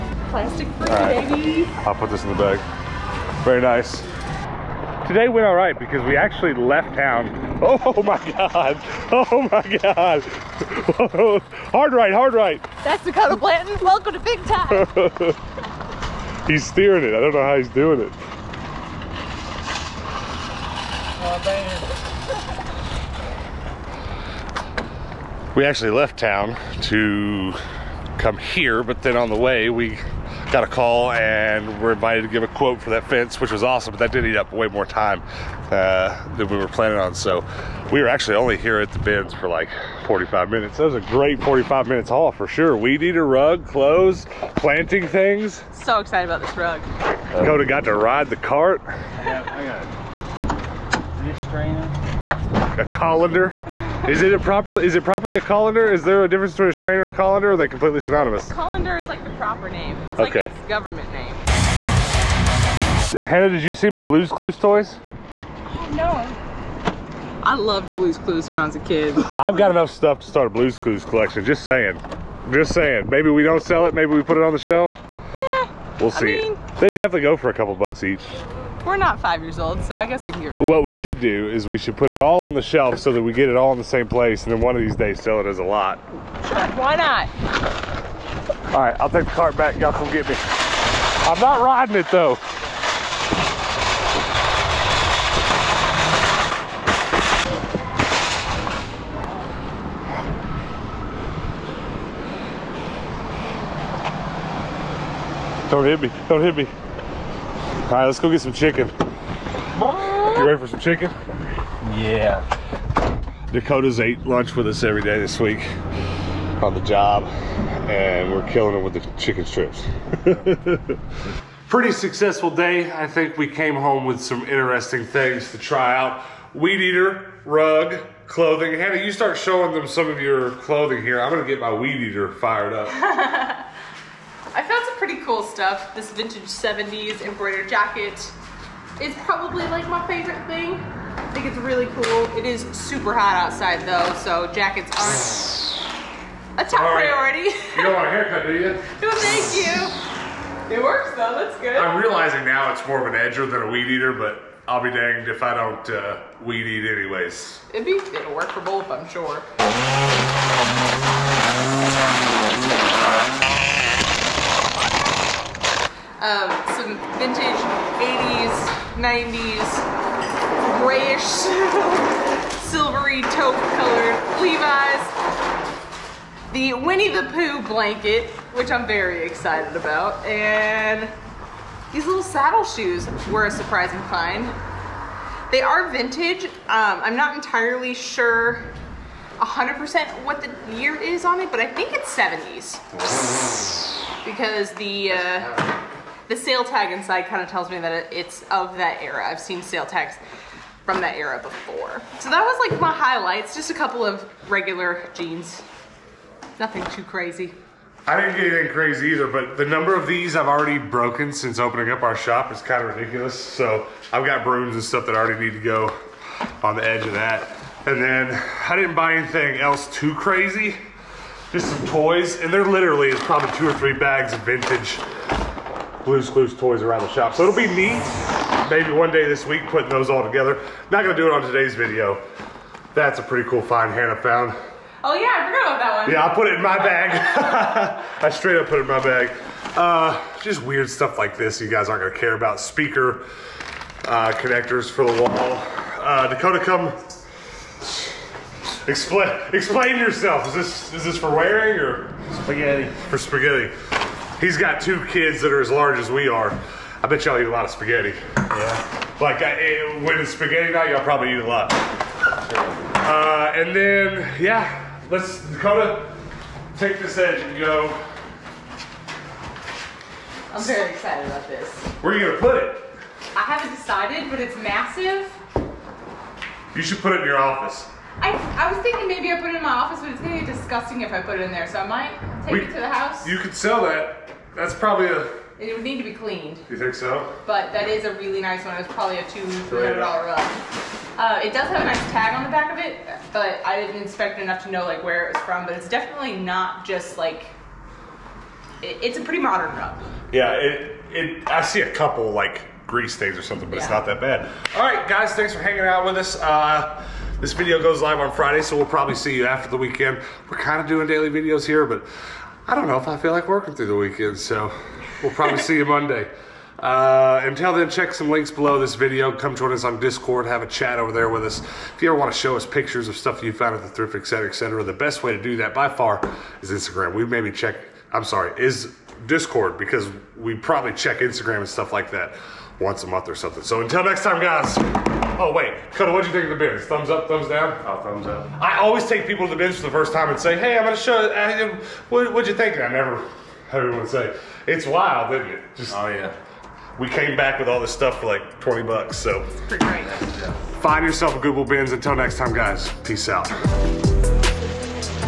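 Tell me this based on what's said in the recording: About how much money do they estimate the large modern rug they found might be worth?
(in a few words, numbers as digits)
$200.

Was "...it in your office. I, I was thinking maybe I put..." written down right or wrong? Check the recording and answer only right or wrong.
right.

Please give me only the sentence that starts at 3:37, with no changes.
And then I didn't buy anything else too crazy, just some toys.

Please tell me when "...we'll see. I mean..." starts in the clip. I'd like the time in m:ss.
1:15.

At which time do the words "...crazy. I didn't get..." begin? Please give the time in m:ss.
3:27.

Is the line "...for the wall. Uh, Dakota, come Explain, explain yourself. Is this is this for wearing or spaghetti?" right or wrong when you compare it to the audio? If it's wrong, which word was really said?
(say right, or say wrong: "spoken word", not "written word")
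right.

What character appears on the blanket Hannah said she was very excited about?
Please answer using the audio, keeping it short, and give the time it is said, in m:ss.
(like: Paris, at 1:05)
Winnie the Pooh, at 2:56.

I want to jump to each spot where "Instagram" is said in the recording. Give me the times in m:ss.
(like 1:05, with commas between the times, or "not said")
5:26, 5:31.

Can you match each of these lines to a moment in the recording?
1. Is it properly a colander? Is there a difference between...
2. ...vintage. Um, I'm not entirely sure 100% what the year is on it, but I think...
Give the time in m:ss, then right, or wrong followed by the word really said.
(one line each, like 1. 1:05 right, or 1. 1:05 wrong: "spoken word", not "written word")
1. 0:54 right
2. 3:05 right.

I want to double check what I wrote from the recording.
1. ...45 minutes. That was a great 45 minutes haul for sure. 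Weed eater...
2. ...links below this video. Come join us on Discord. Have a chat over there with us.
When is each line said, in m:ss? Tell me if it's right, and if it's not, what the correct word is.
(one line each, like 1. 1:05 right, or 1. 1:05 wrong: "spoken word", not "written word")
1. 0:40 right
2. 5:18 right.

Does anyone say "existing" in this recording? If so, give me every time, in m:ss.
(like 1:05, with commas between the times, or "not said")
not said.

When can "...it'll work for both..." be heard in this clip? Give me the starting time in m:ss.
2:37.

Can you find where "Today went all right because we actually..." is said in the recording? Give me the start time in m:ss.
0:05.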